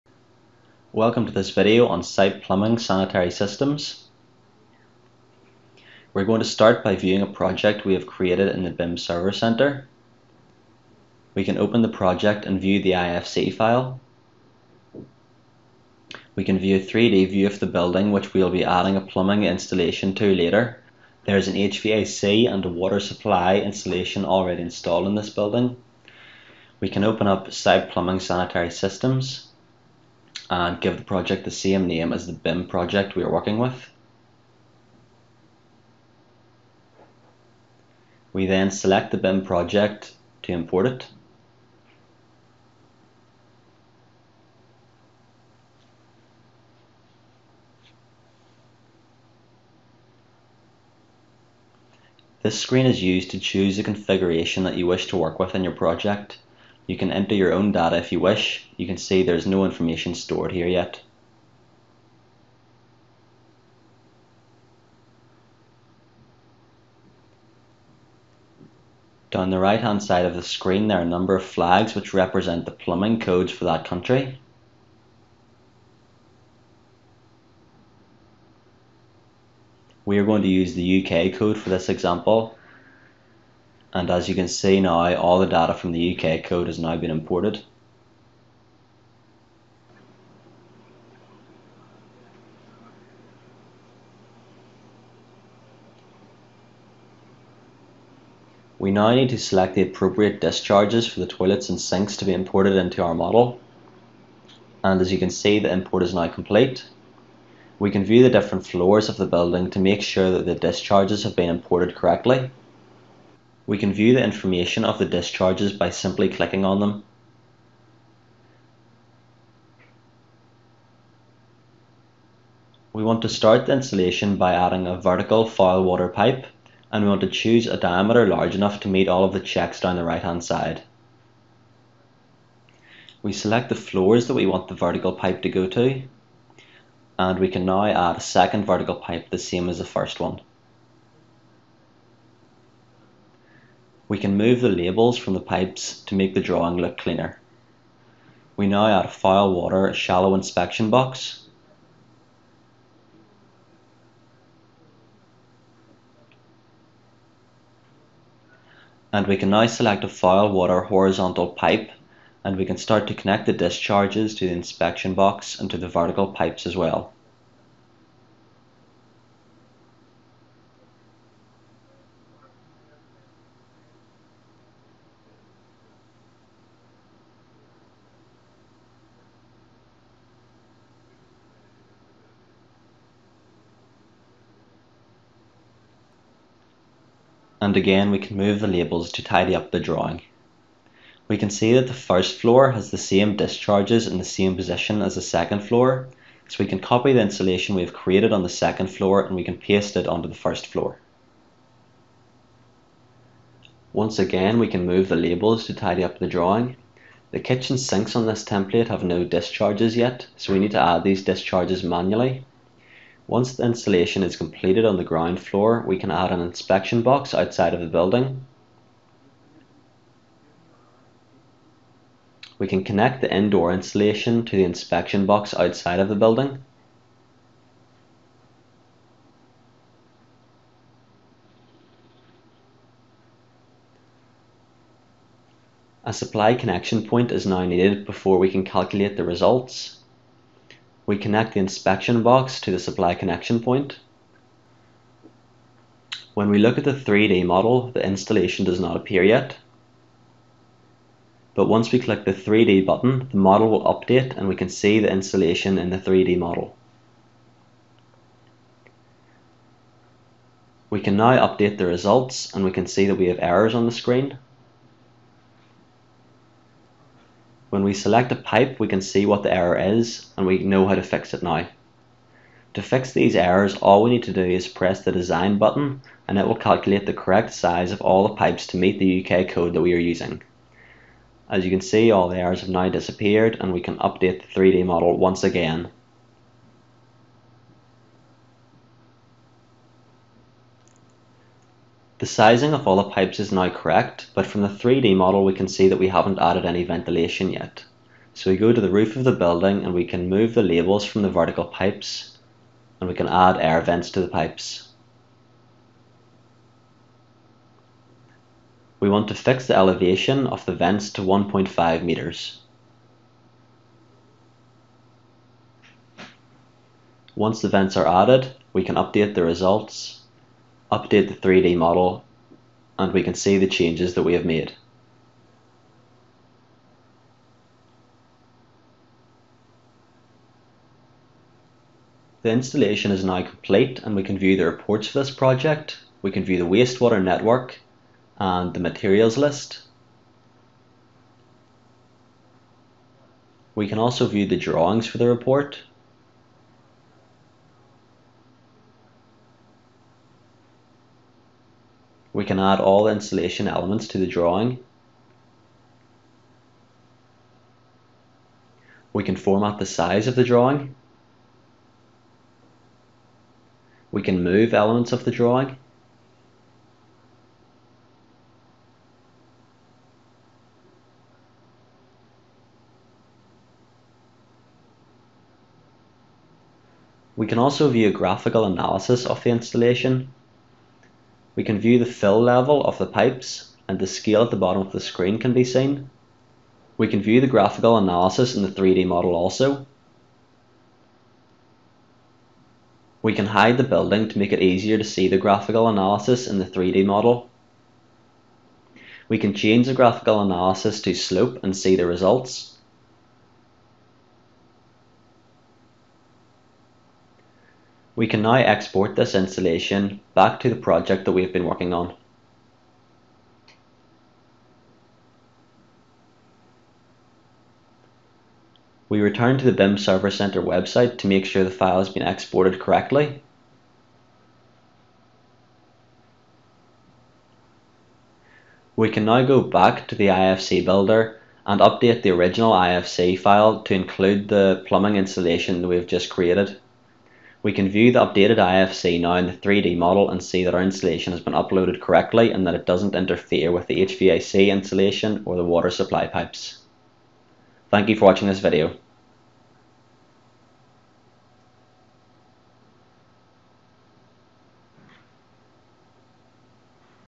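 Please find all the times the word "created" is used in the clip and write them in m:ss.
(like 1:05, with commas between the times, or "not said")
0:08, 3:17, 7:16.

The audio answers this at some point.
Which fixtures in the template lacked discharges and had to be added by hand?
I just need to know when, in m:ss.
3:27.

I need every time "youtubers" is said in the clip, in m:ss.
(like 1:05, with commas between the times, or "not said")
not said.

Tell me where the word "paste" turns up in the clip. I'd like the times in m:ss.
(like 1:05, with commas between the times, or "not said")
3:19.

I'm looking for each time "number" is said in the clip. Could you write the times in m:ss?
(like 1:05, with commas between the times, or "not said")
1:11.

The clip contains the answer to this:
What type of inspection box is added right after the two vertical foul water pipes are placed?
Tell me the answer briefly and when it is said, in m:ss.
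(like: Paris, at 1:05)
Foul water shallow inspection box, at 2:29.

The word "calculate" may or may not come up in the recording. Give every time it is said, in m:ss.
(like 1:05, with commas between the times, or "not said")
3:58, 4:36.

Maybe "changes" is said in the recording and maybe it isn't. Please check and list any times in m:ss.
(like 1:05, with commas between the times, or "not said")
5:23, 6:39.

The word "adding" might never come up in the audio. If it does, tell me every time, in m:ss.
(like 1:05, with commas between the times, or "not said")
0:18, 2:04.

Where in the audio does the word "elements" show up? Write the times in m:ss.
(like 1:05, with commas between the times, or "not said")
5:53, 6:04.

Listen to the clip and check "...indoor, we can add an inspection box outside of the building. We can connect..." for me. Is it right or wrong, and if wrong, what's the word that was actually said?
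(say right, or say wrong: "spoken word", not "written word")
wrong: "floor", not "indoor".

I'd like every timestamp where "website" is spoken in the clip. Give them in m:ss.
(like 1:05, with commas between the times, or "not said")
7:00.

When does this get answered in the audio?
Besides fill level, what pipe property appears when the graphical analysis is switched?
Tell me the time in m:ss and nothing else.
6:41.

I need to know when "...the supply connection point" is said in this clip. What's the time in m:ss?
4:02.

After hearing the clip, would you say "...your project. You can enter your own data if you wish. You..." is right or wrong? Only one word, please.
right.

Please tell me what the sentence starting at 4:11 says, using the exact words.
But once we click the 3D button, the model will update and we can see the installation in the 3D model.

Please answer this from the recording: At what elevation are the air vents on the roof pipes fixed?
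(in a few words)
1.5 meters.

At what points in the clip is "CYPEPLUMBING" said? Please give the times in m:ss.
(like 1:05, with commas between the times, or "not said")
0:02, 0:27.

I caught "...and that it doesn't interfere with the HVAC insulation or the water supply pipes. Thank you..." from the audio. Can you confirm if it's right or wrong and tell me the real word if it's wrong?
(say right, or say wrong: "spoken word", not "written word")
right.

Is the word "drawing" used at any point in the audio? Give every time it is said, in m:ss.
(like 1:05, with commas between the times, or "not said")
2:26, 3:09, 3:26, 5:44, 5:54, 6:00, 6:05.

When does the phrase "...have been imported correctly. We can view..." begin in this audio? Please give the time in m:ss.
1:51.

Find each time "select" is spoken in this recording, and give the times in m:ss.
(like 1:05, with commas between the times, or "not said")
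0:38, 1:39, 2:13, 2:39, 4:27.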